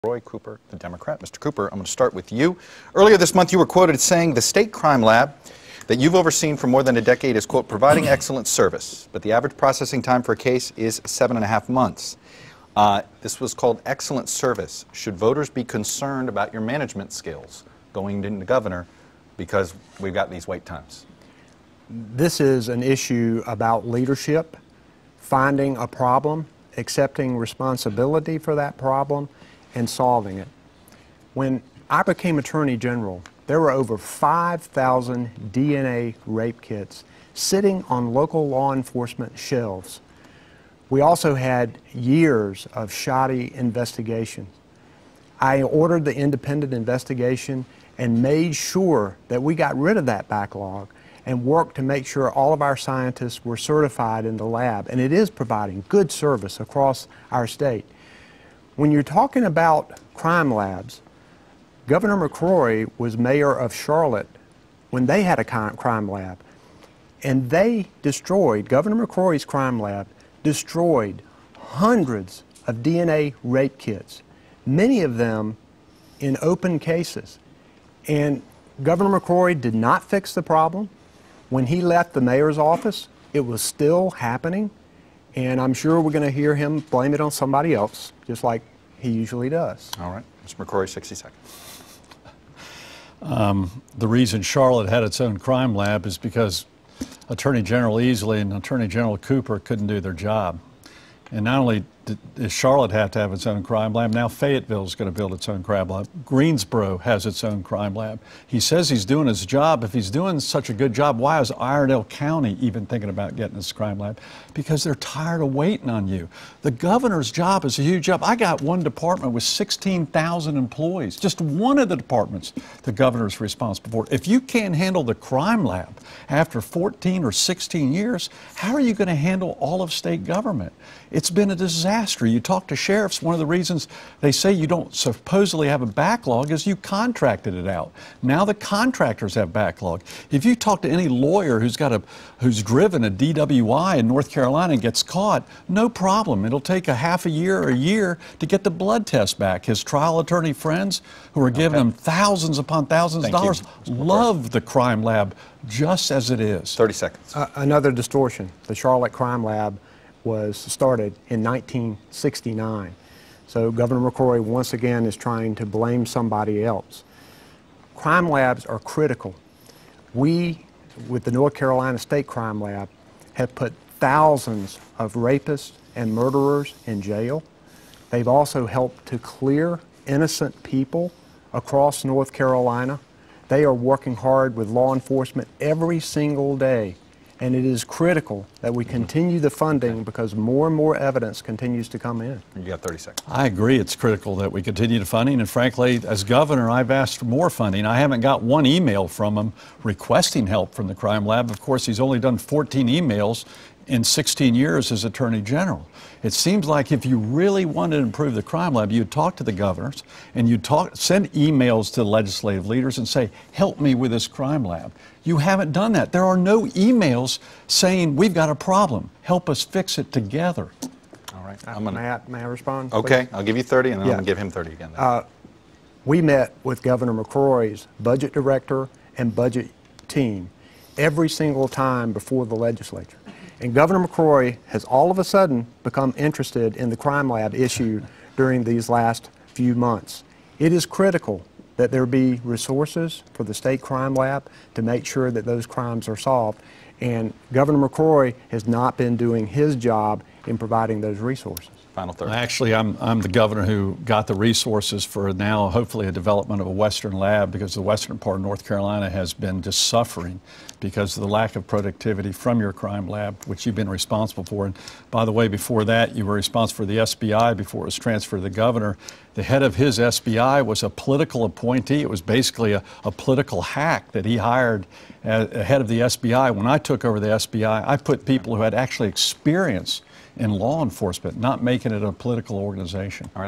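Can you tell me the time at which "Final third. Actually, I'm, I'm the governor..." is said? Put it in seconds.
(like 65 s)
251 s.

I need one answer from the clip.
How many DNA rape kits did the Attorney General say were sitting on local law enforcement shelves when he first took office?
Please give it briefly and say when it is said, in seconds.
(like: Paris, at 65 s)
Over 5,000, at 33 s.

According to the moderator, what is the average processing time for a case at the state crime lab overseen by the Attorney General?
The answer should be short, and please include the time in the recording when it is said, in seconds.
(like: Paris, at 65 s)
7.5 months, at 11 s.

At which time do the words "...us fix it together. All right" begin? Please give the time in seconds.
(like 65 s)
219 s.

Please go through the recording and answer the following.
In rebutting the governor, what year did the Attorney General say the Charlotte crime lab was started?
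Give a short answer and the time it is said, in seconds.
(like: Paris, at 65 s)
1969, at 161 s.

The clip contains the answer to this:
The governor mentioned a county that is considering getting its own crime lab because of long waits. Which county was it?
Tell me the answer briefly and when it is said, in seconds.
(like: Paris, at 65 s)
Iredell County, at 111 s.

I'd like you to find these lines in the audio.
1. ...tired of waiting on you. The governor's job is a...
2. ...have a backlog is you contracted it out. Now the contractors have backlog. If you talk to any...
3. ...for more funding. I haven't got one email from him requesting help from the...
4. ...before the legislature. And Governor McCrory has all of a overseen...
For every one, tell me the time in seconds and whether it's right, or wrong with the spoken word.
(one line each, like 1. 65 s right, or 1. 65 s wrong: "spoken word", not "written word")
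1. 114 s right
2. 135 s right
3. 197 s right
4. 232 s wrong: "sudden", not "overseen".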